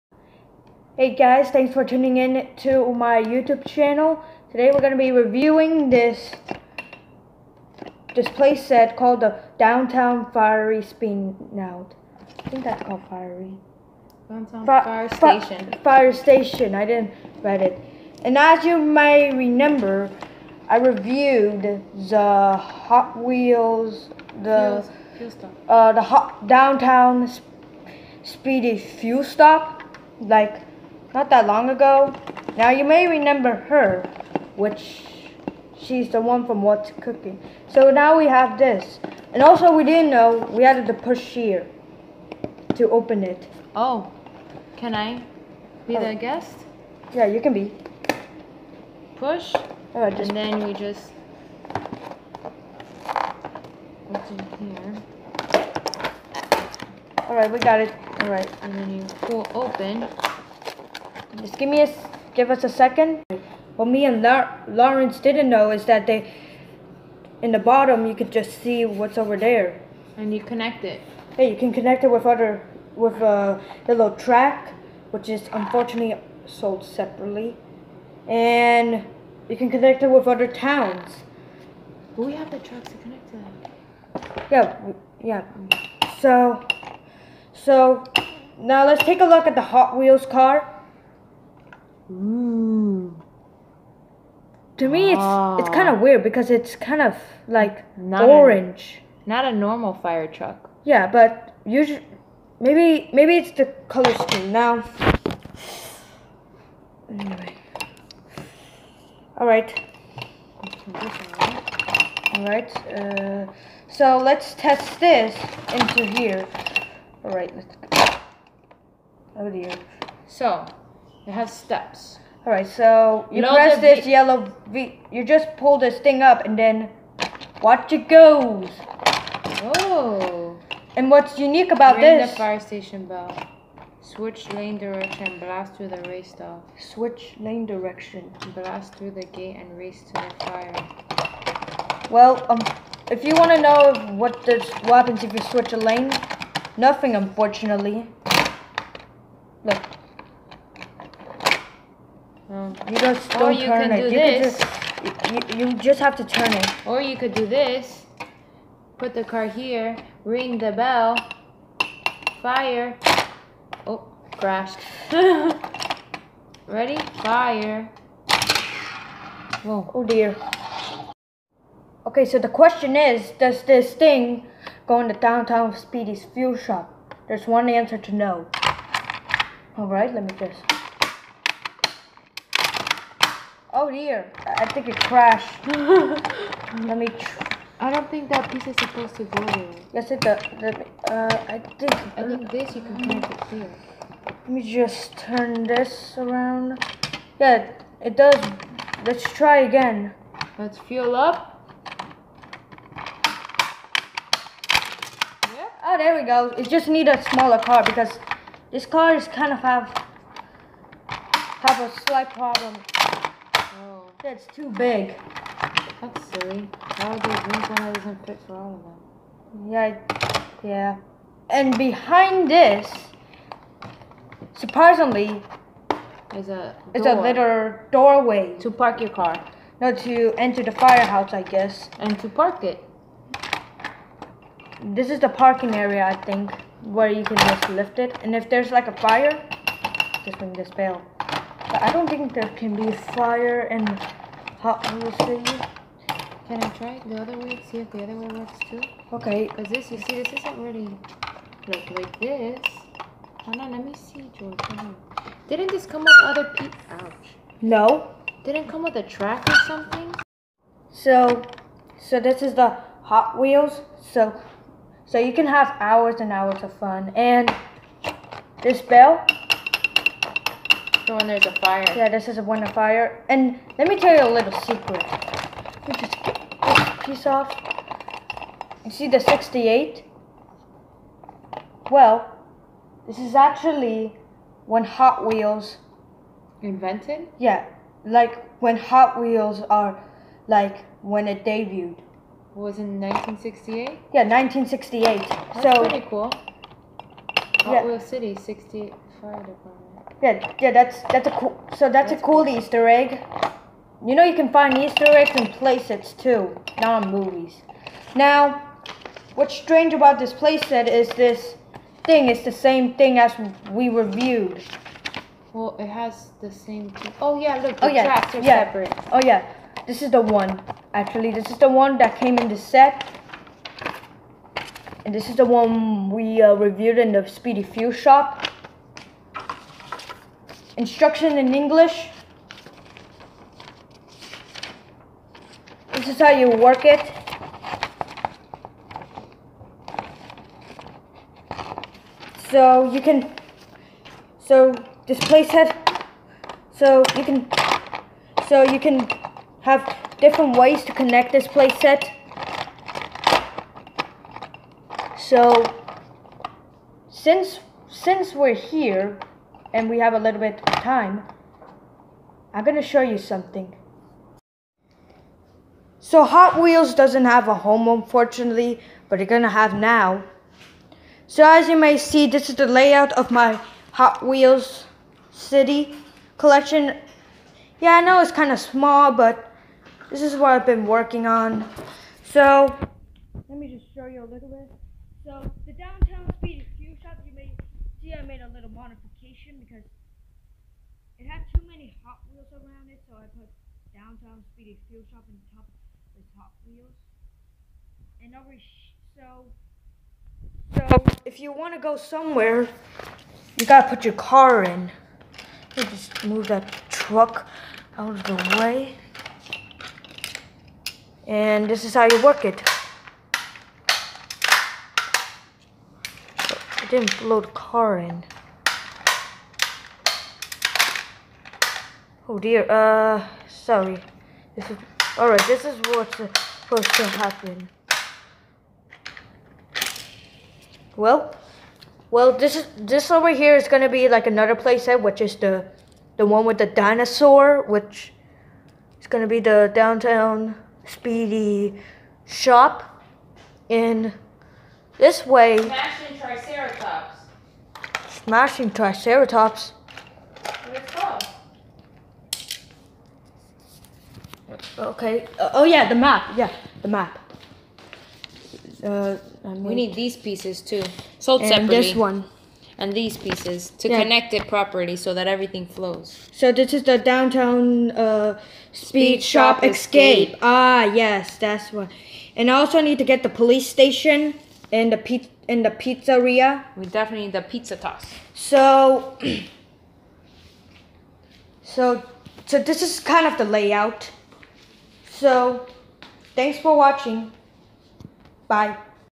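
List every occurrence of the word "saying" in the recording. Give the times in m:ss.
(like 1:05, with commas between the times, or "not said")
not said.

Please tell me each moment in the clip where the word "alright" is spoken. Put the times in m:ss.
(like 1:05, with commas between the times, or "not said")
2:59, 7:05.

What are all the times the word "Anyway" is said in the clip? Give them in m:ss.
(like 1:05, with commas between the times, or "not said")
1:47.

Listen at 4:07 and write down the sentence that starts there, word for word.
See if the other way works too?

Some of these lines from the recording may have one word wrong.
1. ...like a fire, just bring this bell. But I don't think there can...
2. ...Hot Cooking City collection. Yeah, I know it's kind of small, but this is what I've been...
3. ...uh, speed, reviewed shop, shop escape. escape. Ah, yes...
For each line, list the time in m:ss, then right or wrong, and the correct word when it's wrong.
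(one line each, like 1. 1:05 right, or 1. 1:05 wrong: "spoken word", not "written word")
1. 3:58 right
2. 6:13 wrong: "Wheels", not "Cooking"
3. 7:47 wrong: "speed", not "reviewed".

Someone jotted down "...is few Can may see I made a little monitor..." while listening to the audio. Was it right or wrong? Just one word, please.
wrong.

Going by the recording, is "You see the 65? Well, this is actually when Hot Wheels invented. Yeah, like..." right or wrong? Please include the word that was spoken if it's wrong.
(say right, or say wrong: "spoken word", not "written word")
wrong: "68", not "65".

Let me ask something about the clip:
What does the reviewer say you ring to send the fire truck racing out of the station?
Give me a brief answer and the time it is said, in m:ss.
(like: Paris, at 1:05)
fire station bell, at 2:12.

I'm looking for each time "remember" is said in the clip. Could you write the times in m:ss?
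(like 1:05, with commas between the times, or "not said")
0:19, 0:33.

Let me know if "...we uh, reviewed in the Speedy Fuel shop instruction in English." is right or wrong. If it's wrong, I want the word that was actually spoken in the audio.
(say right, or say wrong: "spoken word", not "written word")
right.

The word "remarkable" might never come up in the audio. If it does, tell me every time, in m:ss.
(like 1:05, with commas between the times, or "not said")
not said.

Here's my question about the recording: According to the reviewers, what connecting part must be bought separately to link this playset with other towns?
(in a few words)
the little track.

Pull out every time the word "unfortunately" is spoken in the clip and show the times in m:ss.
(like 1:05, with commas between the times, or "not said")
1:15, 2:27, 6:07.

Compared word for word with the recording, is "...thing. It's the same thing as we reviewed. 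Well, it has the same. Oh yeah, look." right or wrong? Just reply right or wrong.
right.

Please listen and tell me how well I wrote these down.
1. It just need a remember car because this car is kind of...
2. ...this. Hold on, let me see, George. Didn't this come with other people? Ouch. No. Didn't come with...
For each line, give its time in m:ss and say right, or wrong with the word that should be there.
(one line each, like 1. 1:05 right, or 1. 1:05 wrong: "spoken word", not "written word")
1. 3:26 wrong: "smaller", not "remember"
2. 4:12 right.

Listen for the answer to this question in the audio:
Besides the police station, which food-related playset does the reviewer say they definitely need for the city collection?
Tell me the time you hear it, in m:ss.
7:57.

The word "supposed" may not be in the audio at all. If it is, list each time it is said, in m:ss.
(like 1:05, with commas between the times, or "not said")
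3:08, 7:06.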